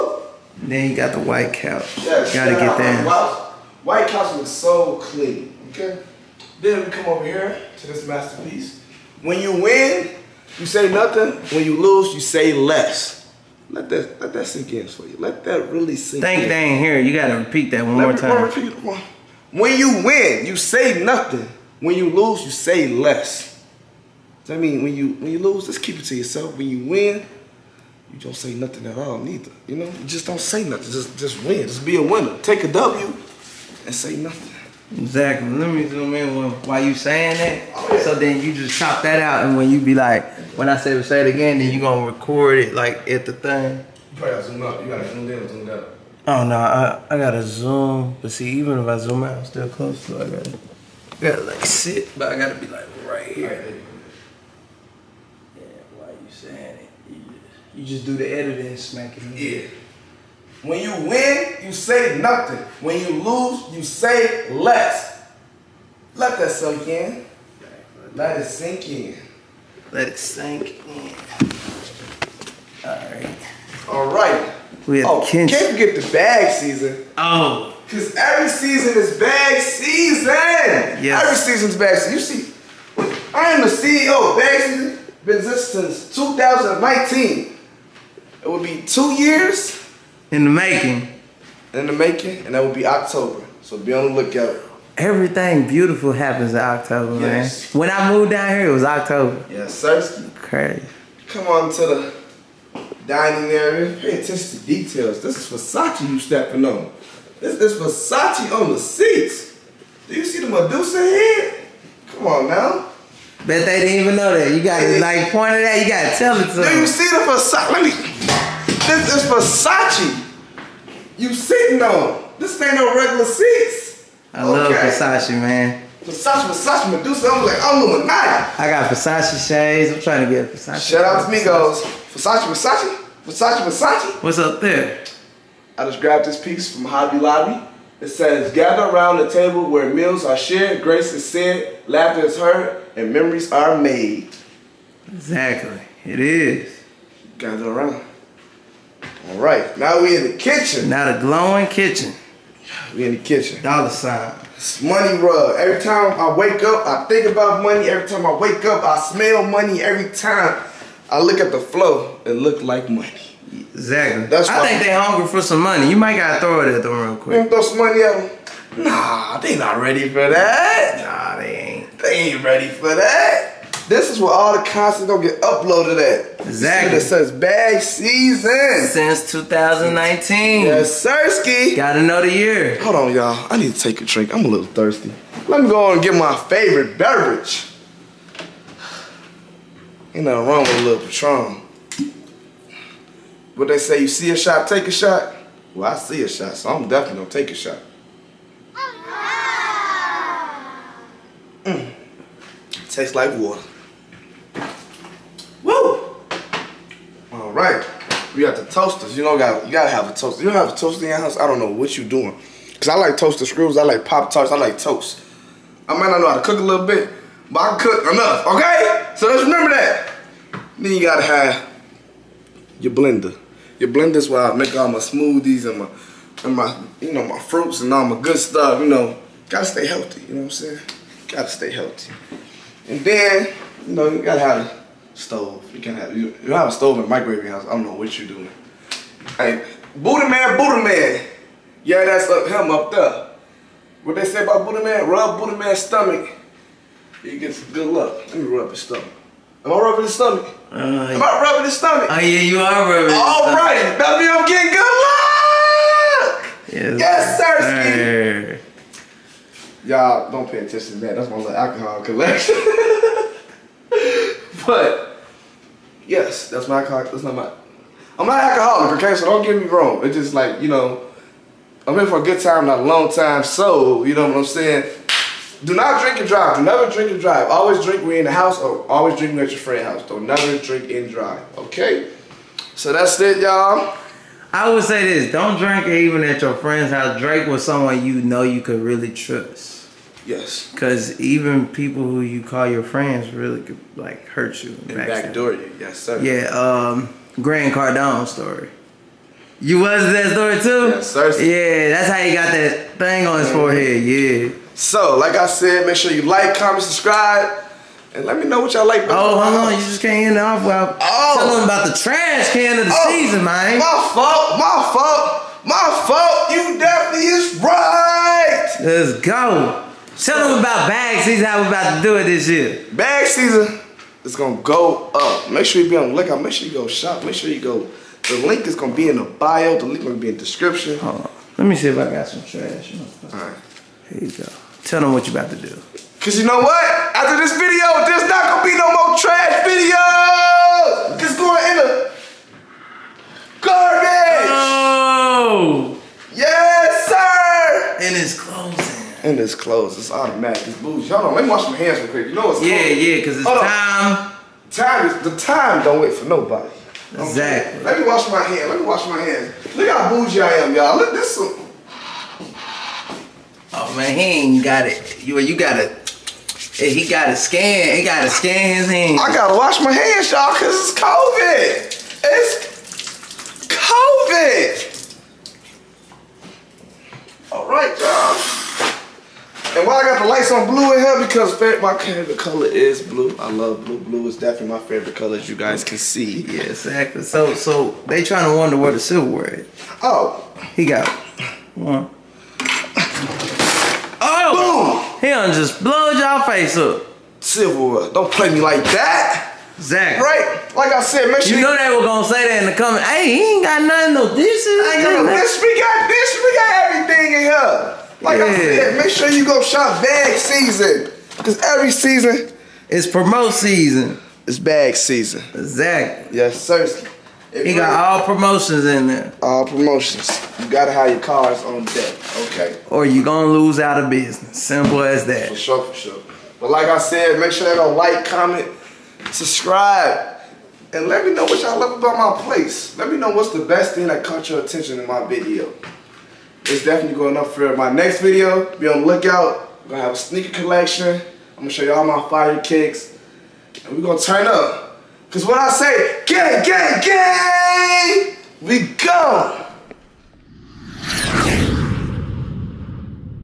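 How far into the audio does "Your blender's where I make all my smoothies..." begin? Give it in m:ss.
3:43.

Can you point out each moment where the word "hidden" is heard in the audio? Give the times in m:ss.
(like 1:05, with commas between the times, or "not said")
not said.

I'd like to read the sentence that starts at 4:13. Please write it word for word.
All right, that means I'm getting good luck.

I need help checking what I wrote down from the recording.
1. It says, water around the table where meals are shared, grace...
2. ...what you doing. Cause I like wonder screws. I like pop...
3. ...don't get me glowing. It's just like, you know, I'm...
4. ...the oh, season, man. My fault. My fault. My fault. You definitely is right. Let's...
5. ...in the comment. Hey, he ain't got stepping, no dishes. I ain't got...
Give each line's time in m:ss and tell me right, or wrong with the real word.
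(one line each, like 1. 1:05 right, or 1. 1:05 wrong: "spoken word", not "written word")
1. 2:18 wrong: "gather", not "water"
2. 3:31 wrong: "toaster", not "wonder"
3. 4:29 wrong: "wrong", not "glowing"
4. 5:12 right
5. 6:42 wrong: "nothing", not "stepping".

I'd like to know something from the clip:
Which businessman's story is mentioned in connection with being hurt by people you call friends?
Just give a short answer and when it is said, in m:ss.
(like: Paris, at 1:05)
Grant Cardone, at 4:57.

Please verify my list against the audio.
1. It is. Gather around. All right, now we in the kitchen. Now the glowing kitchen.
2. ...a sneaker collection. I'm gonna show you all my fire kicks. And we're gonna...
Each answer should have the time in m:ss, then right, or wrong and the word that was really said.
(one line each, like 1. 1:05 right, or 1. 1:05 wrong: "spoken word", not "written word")
1. 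2:26 right
2. 7:20 right.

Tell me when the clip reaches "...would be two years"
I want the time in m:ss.
1:28.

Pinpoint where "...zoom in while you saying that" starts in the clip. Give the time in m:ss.
0:35.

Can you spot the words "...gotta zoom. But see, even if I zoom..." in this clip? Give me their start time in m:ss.
0:47.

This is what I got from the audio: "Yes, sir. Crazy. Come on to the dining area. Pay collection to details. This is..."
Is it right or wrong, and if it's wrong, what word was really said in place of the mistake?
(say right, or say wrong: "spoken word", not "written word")
wrong: "attention", not "collection".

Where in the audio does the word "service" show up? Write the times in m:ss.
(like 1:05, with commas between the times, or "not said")
not said.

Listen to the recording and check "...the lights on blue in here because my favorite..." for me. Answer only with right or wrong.
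right.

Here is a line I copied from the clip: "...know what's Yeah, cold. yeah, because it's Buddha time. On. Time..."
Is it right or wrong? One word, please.
wrong.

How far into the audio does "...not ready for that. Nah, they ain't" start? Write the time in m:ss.
2:49.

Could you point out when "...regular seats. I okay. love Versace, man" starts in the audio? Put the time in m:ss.
2:02.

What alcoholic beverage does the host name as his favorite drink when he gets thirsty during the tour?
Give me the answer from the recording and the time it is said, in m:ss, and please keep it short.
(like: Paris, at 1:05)
Patron, at 3:11.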